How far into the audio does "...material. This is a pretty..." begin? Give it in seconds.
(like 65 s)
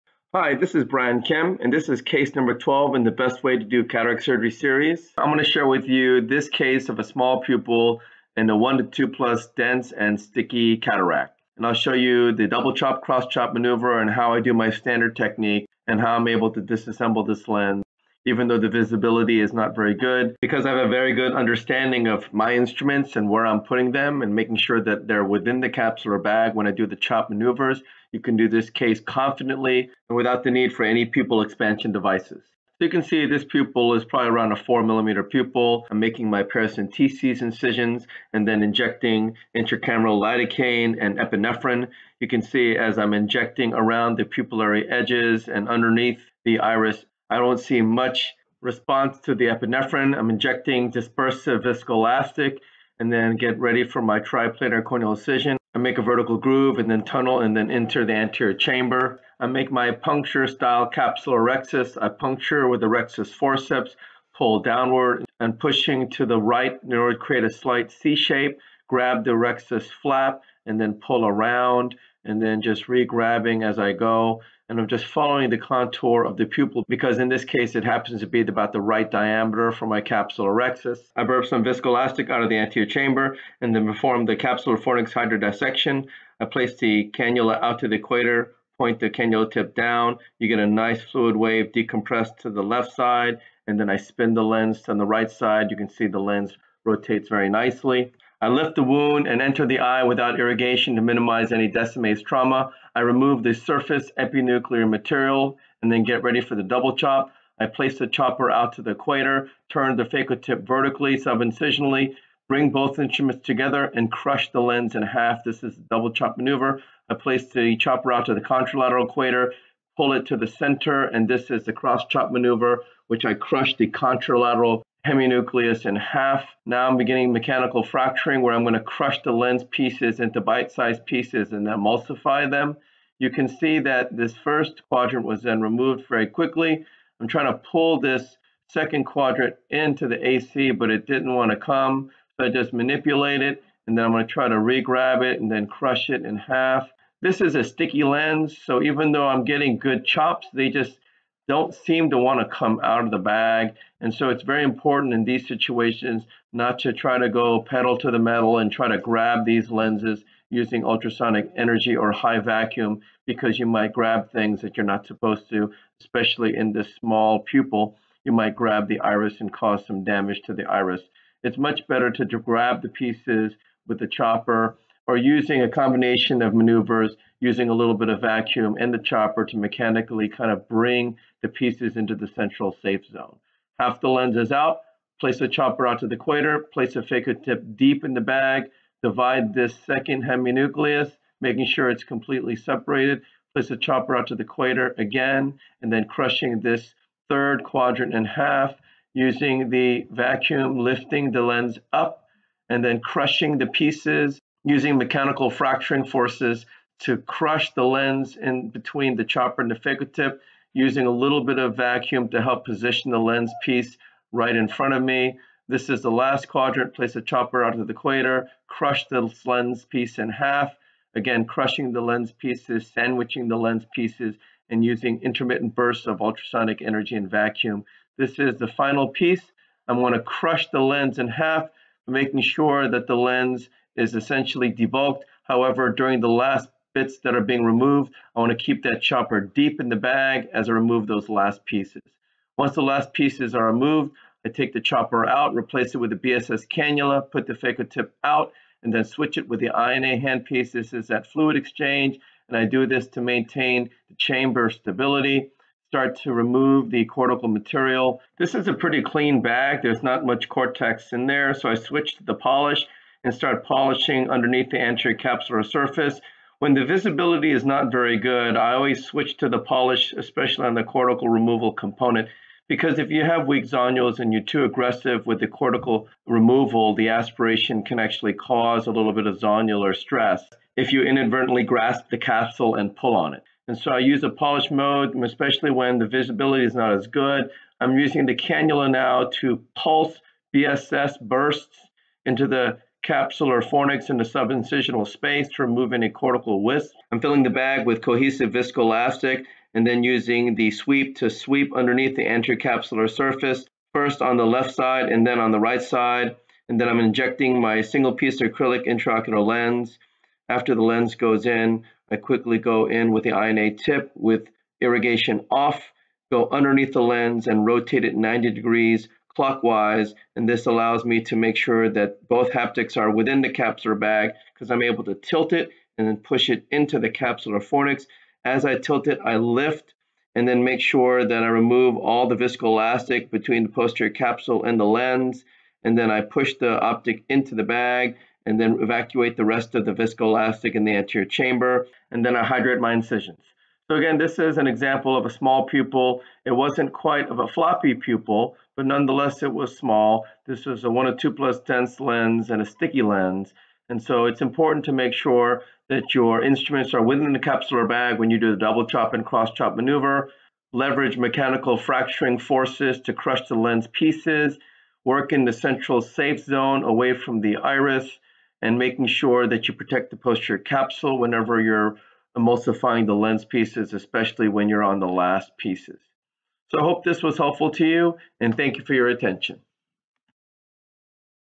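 257 s.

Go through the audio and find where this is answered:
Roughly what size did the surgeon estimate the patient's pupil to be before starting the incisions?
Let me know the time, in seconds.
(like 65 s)
34 s.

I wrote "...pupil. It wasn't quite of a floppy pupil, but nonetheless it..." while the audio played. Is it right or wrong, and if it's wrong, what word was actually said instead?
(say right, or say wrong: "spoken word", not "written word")
right.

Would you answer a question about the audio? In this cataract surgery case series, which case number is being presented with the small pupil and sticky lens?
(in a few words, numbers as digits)
12.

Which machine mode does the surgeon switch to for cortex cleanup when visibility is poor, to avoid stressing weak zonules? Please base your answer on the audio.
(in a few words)
polish mode.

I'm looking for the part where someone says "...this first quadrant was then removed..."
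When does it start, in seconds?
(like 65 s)
134 s.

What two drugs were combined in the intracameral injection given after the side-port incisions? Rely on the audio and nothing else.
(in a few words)
lidocaine and epinephrine.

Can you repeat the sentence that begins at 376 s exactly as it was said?
So I hope this was helpful to you, and thank you for your attention.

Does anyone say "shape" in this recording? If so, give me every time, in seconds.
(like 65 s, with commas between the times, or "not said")
68 s.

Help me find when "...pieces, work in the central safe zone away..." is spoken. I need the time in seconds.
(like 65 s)
363 s.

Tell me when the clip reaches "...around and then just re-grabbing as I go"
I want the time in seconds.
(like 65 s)
71 s.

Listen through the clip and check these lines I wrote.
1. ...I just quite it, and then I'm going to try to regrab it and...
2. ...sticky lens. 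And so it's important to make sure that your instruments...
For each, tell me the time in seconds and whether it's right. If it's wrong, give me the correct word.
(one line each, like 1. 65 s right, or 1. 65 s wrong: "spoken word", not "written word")
1. 142 s wrong: "manipulate", not "quite"
2. 352 s right.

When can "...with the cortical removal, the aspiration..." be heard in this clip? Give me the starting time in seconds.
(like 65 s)
275 s.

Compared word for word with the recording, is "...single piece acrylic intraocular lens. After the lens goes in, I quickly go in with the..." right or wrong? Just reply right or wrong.
right.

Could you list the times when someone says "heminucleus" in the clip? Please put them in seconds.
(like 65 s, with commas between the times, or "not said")
125 s, 190 s.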